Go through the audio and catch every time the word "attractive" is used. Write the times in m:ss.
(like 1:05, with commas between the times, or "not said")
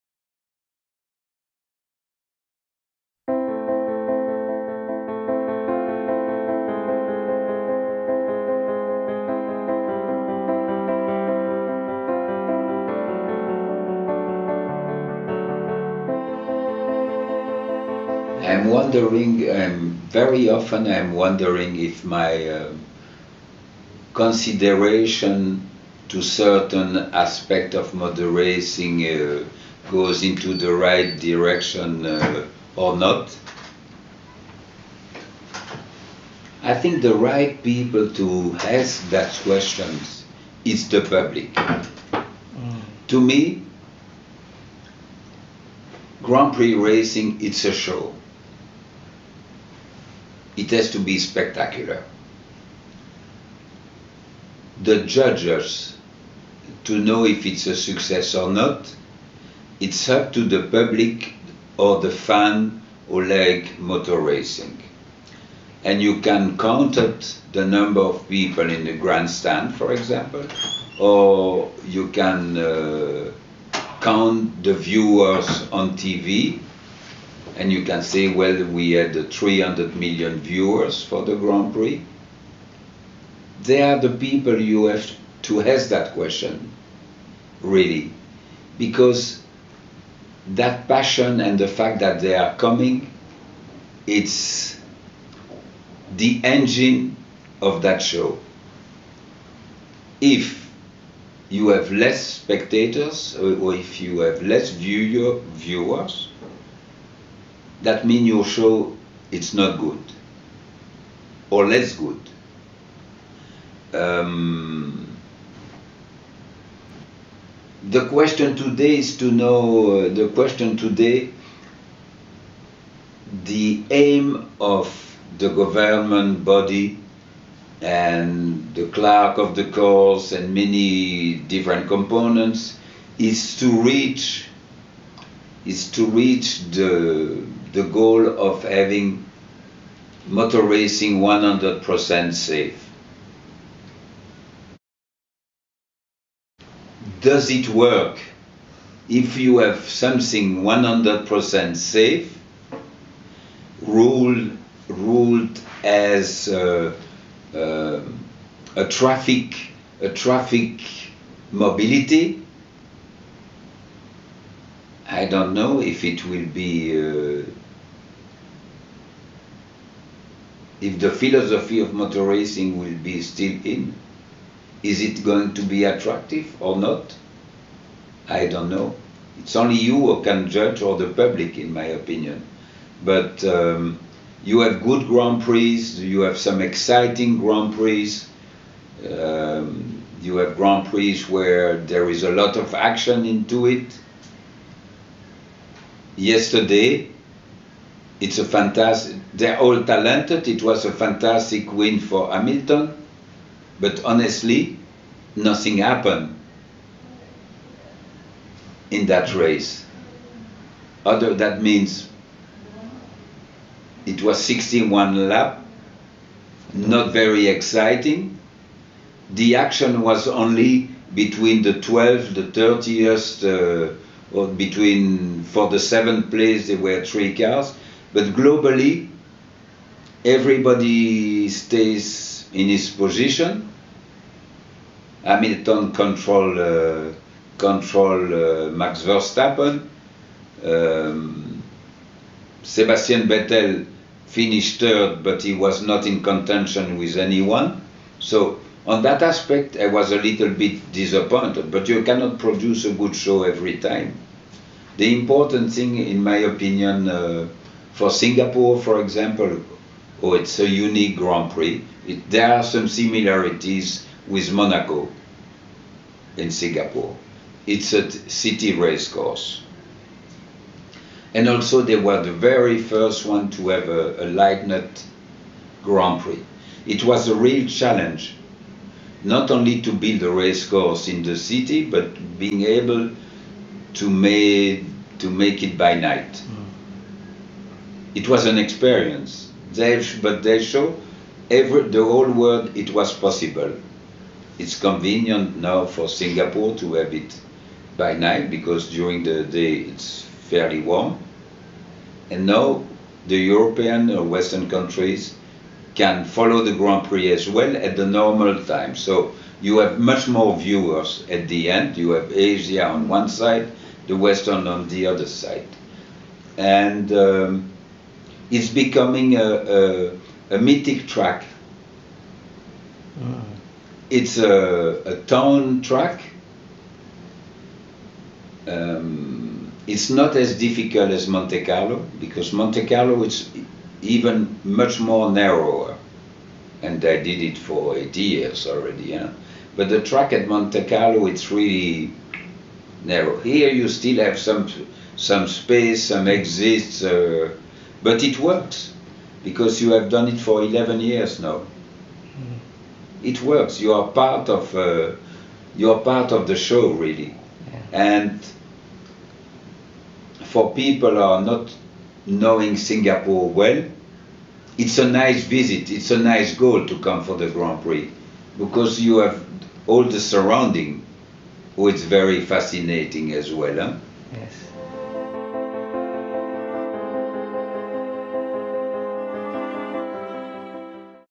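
2:55.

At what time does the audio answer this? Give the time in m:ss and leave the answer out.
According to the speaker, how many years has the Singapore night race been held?
5:50.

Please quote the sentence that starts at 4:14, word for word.
The important thing, in my opinion, uh, for Singapore, for example, oh, it's a unique Grand Prix.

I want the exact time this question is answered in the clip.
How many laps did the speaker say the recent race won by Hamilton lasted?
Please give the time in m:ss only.
3:34.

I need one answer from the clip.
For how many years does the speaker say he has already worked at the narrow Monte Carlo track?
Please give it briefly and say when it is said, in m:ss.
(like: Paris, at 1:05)
8, at 5:37.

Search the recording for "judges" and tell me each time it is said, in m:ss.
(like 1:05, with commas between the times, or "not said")
0:55, 3:00.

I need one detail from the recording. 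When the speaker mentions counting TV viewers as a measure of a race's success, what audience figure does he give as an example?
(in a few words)
300 million.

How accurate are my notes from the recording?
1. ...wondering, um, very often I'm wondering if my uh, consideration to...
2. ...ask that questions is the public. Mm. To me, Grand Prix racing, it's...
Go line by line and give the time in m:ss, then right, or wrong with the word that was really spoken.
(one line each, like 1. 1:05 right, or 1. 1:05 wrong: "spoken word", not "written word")
1. 0:18 right
2. 0:38 right.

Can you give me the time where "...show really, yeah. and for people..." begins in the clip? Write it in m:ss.
5:56.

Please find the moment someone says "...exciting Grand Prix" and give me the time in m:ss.
3:06.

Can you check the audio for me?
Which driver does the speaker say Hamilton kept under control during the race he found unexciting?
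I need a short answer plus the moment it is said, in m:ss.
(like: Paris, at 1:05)
Max Verstappen, at 3:58.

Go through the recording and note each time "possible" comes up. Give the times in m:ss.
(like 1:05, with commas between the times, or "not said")
4:53.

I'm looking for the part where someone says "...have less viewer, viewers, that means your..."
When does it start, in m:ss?
1:44.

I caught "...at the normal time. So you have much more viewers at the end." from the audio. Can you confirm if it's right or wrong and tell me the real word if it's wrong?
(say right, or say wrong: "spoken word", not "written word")
right.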